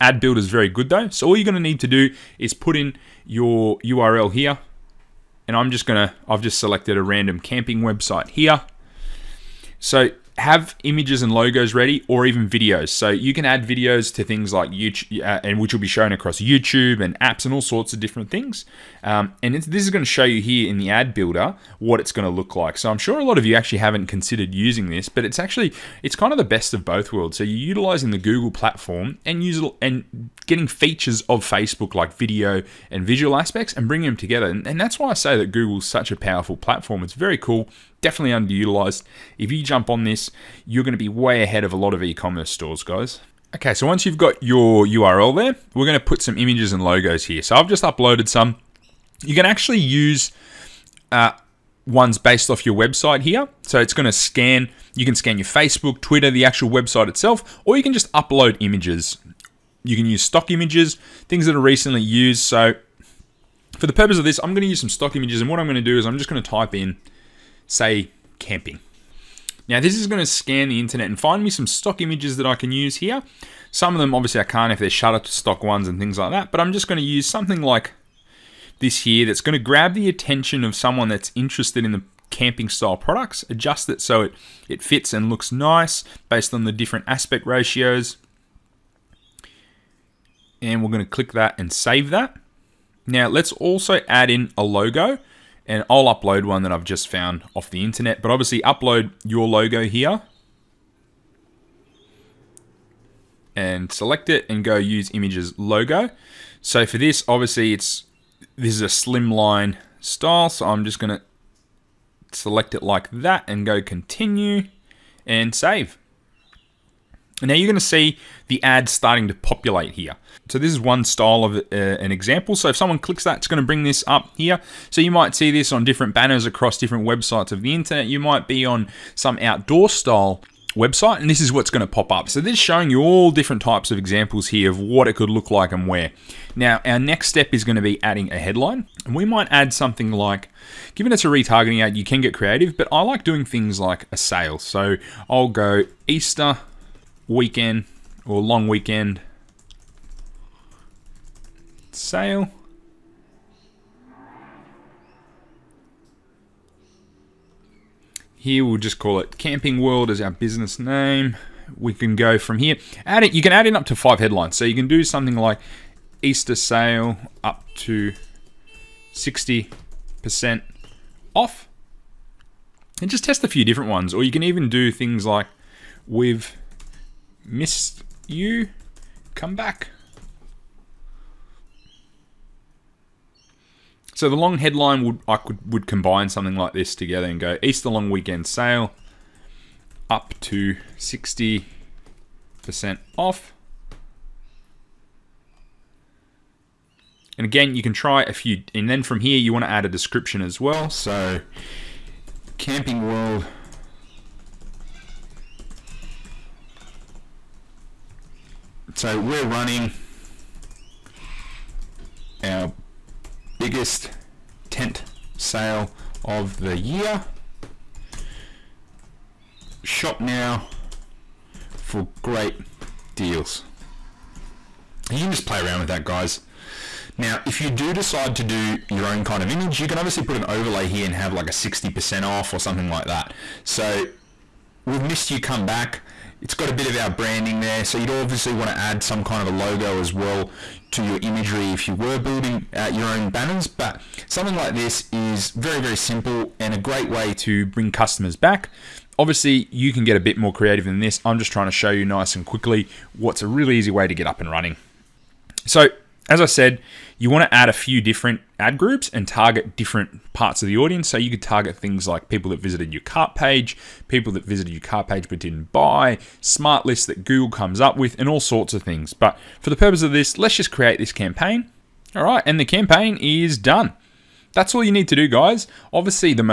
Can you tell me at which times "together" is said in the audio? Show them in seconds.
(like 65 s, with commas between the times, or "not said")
34 s, 186 s.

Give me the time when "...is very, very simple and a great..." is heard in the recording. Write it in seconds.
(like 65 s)
245 s.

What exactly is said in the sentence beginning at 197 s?
And again, you can try a few, and then from here you want to add a description as well.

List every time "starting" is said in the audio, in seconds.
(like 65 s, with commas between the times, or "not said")
118 s.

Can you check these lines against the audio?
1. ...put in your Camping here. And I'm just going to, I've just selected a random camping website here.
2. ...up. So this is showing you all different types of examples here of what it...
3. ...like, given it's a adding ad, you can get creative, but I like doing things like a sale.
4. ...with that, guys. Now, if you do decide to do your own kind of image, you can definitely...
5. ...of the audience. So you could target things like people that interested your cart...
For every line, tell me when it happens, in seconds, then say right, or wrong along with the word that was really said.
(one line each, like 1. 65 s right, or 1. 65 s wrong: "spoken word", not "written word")
1. 2 s wrong: "URL", not "Camping"
2. 132 s right
3. 140 s wrong: "retargeting", not "adding"
4. 225 s wrong: "obviously", not "definitely"
5. 260 s wrong: "visited", not "interested".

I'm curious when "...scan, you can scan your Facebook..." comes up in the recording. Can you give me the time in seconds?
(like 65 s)
54 s.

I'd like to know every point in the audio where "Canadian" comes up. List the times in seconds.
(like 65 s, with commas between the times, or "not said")
not said.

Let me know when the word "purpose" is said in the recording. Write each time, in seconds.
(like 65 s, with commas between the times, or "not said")
63 s, 269 s.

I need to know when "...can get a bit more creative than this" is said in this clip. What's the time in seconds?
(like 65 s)
249 s.